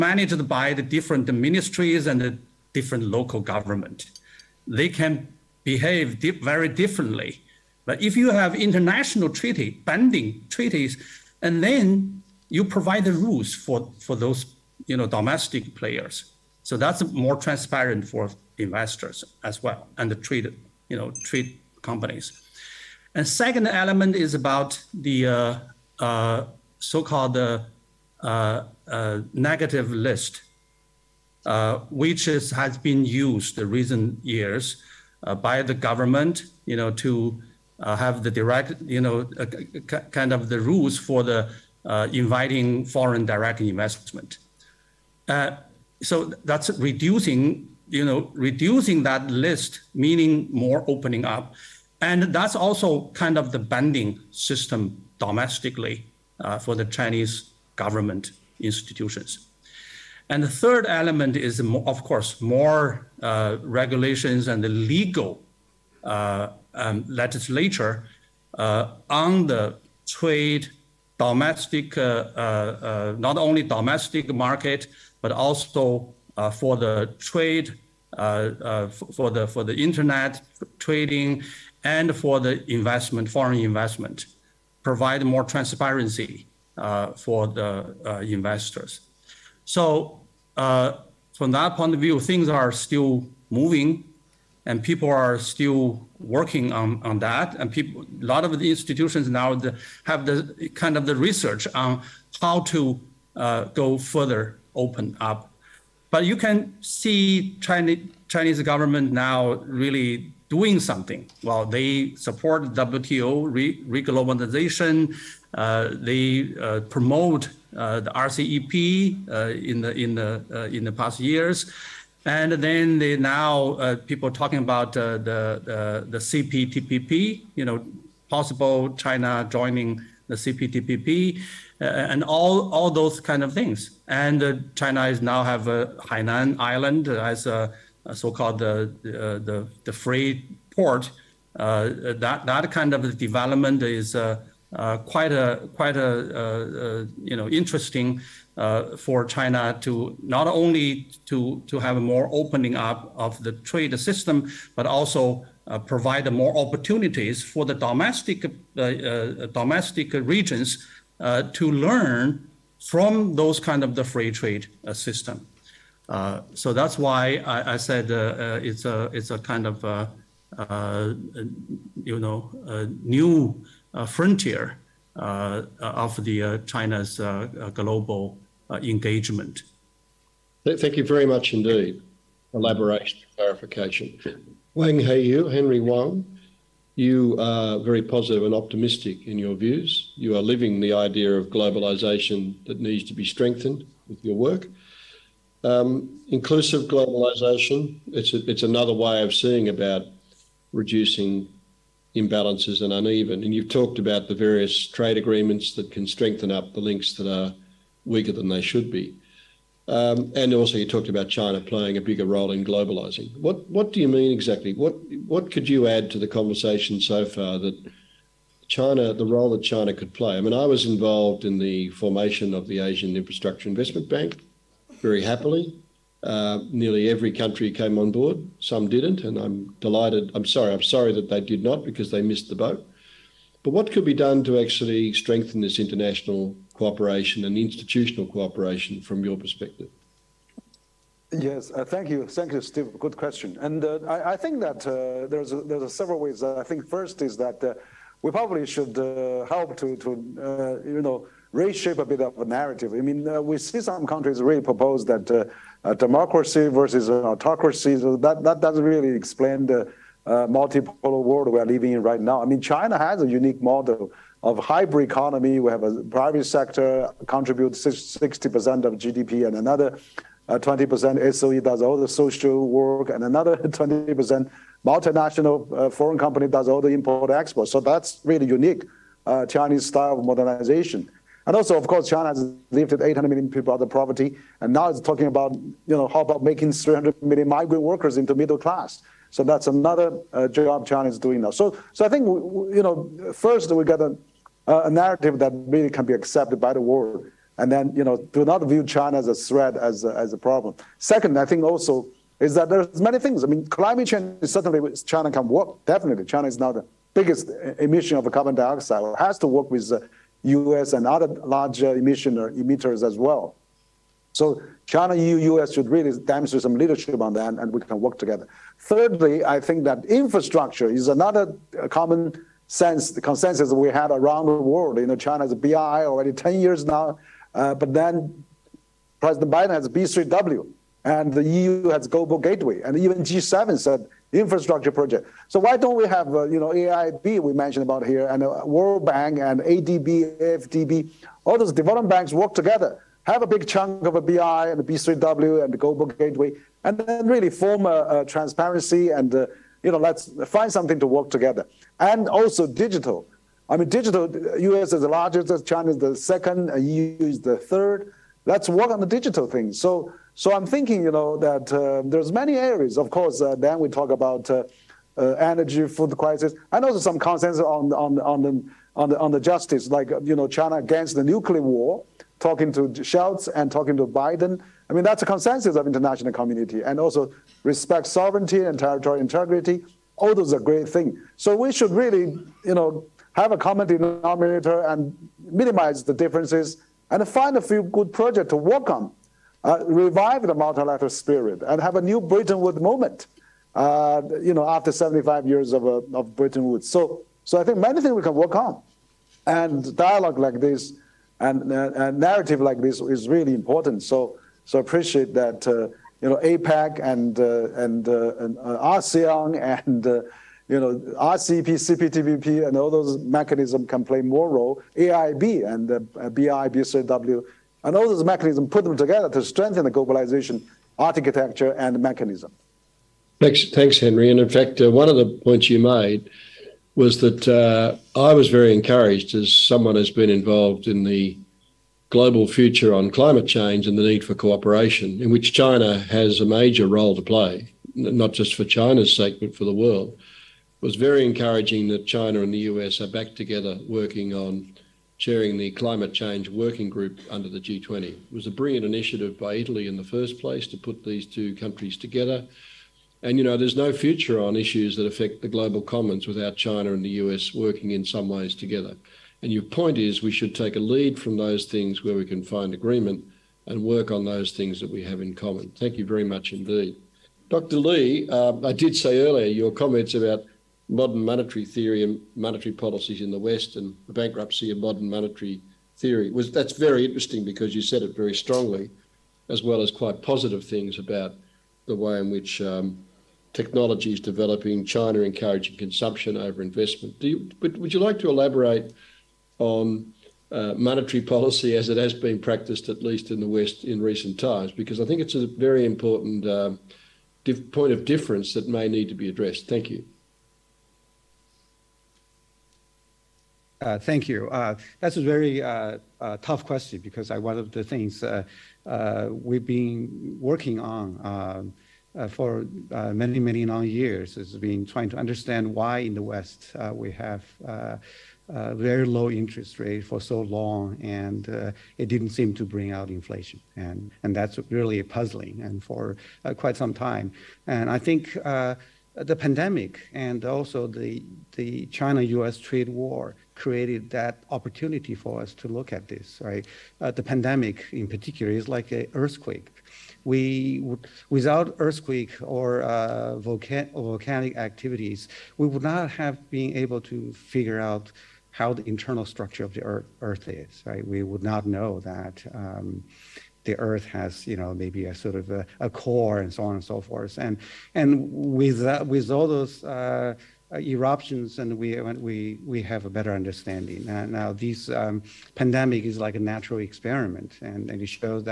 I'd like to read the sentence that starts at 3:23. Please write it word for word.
And you've talked about the various trade agreements that can strengthen up the links that are weaker than they should be.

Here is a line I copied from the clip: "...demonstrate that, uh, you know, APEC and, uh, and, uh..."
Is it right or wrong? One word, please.
wrong.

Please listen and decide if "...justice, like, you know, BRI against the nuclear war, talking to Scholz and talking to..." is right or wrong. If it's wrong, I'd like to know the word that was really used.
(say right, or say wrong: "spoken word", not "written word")
wrong: "China", not "BRI".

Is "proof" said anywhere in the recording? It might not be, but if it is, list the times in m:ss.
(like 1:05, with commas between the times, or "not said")
not said.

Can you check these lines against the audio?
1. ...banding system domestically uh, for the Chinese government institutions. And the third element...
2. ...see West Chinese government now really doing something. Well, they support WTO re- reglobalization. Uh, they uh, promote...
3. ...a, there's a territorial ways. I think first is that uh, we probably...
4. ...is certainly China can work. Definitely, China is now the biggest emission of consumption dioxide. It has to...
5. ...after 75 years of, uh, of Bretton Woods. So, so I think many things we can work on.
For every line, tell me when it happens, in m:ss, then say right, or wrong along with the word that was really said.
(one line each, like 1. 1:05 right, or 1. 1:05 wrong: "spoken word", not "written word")
1. 0:53 right
2. 1:46 wrong: "Chinese", not "West"
3. 4:05 wrong: "several", not "territorial"
4. 5:04 wrong: "carbon", not "consumption"
5. 6:34 right.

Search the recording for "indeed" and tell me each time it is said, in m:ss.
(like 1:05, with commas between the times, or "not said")
3:01, 7:46.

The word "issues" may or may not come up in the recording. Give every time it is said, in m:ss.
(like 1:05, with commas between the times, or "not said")
7:34.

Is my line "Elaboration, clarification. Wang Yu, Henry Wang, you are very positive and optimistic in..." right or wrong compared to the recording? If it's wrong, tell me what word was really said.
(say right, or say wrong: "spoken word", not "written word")
right.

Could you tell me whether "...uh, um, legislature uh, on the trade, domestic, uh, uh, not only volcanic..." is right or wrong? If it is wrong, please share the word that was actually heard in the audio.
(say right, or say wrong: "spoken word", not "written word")
wrong: "domestic", not "volcanic".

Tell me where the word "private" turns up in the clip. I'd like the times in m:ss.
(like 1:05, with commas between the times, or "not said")
4:26.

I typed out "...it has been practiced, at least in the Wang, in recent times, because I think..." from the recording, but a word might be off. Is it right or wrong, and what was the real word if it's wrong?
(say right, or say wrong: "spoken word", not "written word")
wrong: "West", not "Wang".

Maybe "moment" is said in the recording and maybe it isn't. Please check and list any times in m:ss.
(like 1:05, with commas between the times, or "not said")
6:32.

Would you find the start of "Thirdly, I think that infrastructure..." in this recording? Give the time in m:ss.
5:18.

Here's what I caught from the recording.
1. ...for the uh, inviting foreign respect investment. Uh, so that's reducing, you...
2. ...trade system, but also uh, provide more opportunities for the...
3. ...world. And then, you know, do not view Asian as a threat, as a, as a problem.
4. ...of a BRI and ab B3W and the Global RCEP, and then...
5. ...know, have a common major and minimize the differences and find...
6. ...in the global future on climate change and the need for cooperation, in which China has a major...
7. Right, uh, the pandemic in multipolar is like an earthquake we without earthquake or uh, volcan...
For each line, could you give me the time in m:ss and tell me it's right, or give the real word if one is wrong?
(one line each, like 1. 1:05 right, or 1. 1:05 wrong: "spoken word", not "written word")
1. 0:40 wrong: "direct", not "respect"
2. 2:33 right
3. 4:56 wrong: "China", not "Asian"
4. 5:44 wrong: "Gateway", not "RCEP"
5. 6:22 wrong: "denominator", not "major"
6. 7:10 right
7. 8:56 wrong: "particular", not "multipolar".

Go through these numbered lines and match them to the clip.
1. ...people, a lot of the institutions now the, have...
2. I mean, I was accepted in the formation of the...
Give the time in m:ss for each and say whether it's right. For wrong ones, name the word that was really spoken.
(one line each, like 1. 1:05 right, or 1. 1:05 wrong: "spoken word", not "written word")
1. 1:37 right
2. 3:40 wrong: "involved", not "accepted".